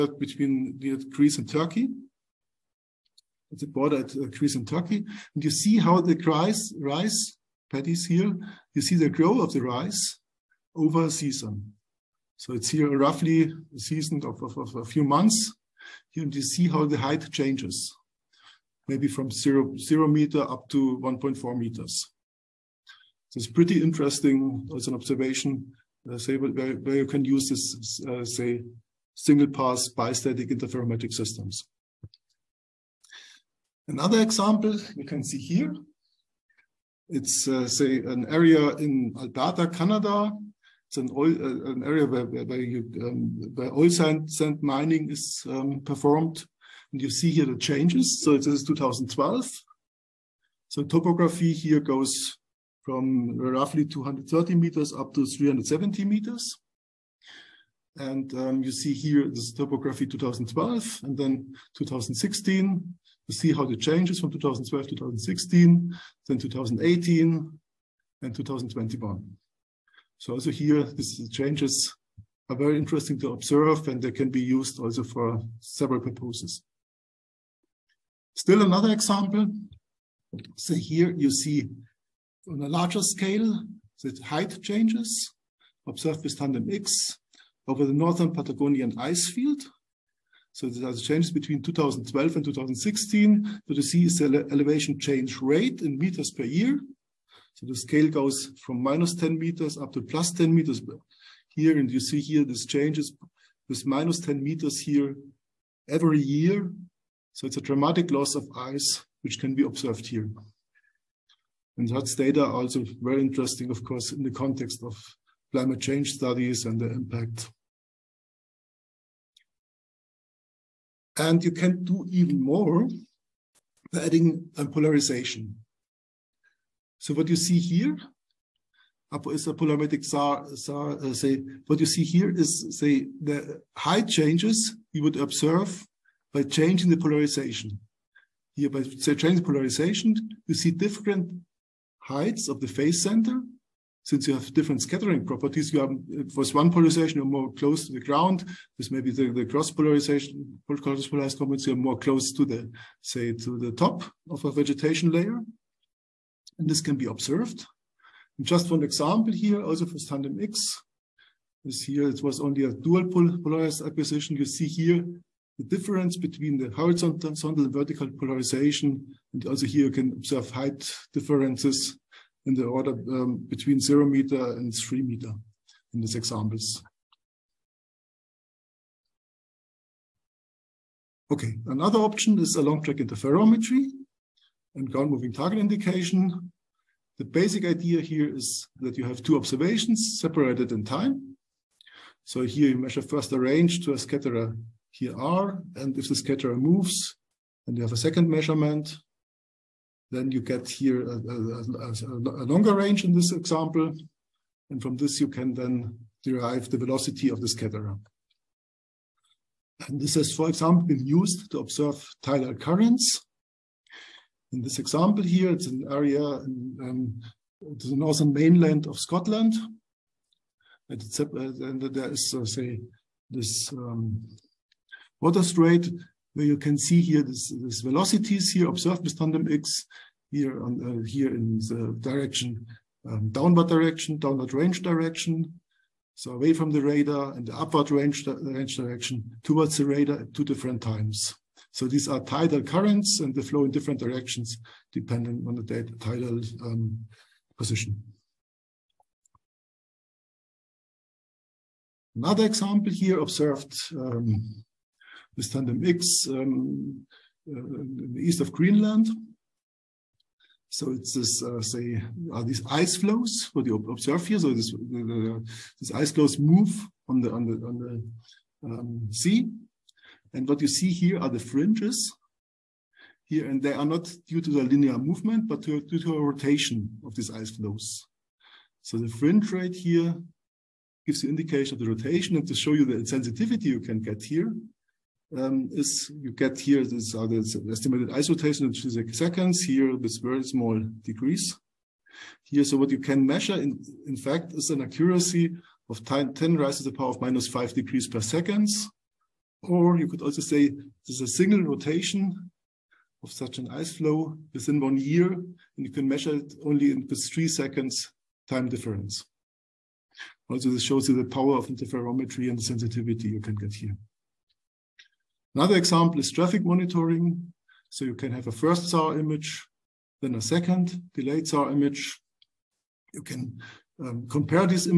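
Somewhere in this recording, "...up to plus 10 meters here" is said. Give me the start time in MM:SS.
01:39.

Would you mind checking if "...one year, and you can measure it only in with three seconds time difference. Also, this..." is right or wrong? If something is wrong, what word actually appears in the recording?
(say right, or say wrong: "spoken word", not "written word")
right.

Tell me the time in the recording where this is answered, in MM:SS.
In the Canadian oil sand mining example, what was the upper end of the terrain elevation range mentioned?
00:55.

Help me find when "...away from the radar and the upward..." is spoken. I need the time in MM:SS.
03:56.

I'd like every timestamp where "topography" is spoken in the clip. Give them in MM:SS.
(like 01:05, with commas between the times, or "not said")
00:50, 00:59.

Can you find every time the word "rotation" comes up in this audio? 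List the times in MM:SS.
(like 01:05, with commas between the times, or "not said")
04:36, 04:41, 04:48, 05:01.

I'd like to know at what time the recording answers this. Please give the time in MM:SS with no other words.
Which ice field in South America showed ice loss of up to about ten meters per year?
01:27.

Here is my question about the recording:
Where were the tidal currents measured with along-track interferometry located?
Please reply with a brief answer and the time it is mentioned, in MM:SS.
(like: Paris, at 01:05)
Northern mainland of Scotland, at 03:37.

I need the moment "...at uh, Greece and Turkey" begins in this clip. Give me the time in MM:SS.
00:03.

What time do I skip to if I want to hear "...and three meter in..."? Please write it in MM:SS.
02:54.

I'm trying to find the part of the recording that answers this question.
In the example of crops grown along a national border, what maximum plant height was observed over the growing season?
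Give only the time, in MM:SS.
00:21.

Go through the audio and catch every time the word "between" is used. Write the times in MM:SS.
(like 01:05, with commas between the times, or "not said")
00:00, 01:31, 02:46, 02:53.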